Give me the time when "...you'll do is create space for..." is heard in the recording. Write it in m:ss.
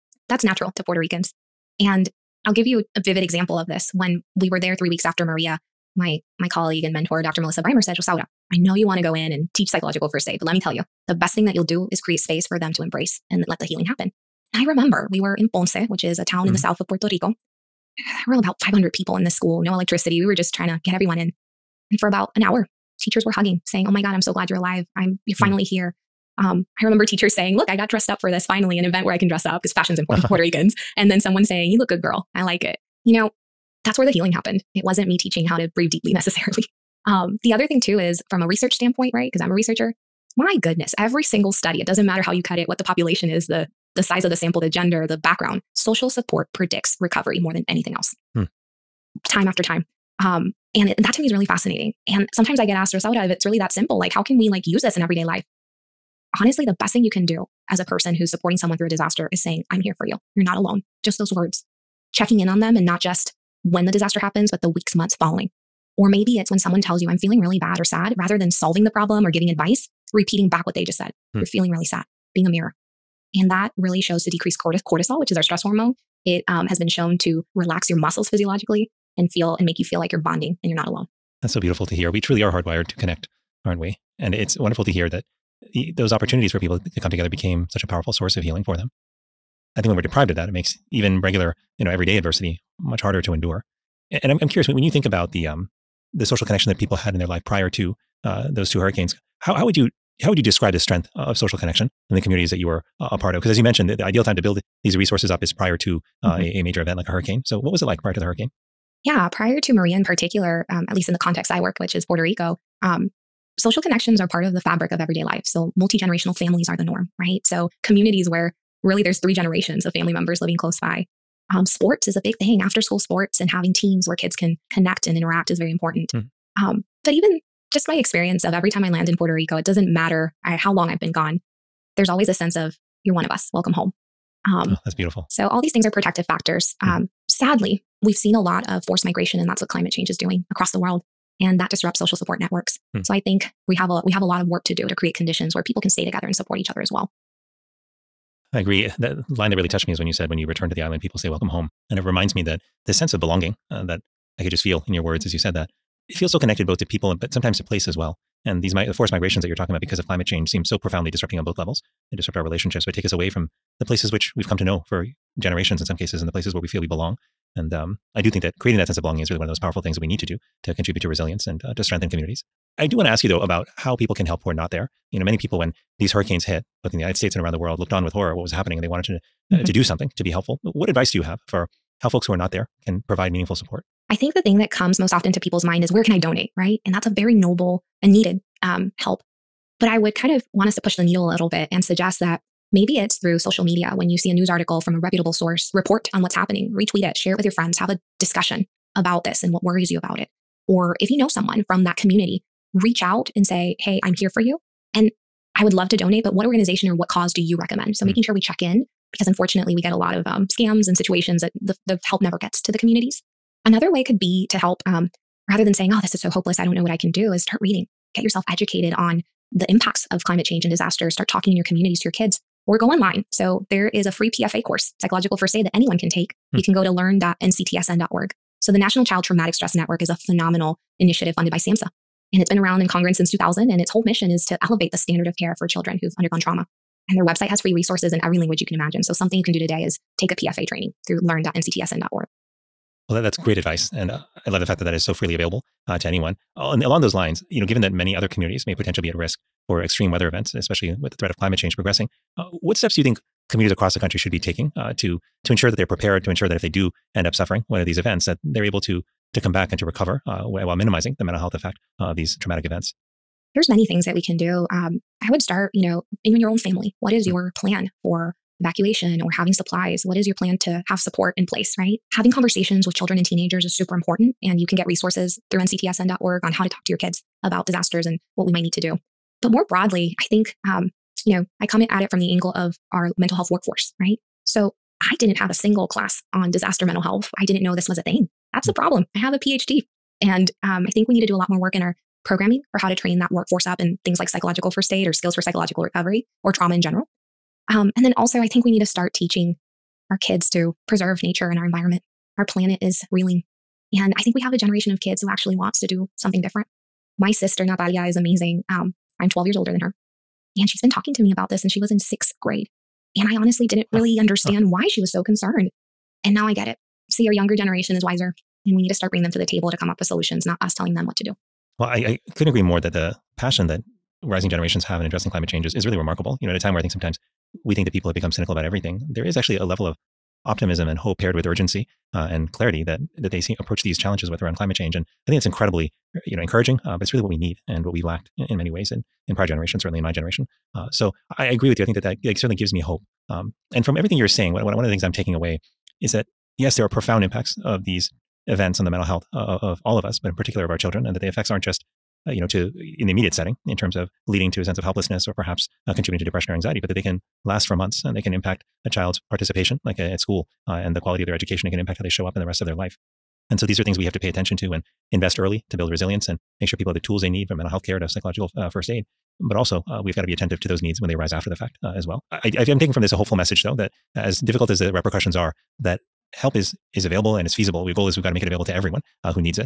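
0:11.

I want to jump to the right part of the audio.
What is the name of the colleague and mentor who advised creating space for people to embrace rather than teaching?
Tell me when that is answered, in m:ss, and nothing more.
0:07.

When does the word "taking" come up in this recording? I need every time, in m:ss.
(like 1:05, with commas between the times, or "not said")
4:14, 5:45, 6:12.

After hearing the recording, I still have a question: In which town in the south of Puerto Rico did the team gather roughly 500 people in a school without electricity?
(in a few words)
Ponce.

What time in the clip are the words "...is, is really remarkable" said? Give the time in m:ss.
5:25.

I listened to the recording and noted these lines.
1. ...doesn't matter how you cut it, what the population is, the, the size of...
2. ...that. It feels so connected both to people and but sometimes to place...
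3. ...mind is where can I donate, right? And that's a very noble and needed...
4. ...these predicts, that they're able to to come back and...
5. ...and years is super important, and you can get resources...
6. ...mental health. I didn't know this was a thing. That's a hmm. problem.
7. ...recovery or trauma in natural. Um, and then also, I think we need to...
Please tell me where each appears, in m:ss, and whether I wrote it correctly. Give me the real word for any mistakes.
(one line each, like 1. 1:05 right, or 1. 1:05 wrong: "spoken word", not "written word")
1. 0:41 right
2. 2:35 right
3. 3:05 right
4. 4:17 wrong: "events", not "predicts"
5. 4:33 wrong: "teenagers", not "years"
6. 4:46 right
7. 4:55 wrong: "general", not "natural".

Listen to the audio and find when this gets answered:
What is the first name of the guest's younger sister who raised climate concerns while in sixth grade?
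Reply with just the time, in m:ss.
5:07.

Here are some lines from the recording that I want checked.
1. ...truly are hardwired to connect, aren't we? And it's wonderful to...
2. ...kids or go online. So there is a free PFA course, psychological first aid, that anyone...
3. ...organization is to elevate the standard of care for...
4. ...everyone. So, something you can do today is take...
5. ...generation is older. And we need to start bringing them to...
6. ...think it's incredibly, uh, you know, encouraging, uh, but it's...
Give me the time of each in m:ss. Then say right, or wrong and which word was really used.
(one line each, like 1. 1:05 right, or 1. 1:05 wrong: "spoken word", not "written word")
1. 1:22 right
2. 3:42 right
3. 3:54 wrong: "mission", not "organization"
4. 3:58 wrong: "imagine", not "everyone"
5. 5:17 wrong: "wiser", not "older"
6. 5:35 right.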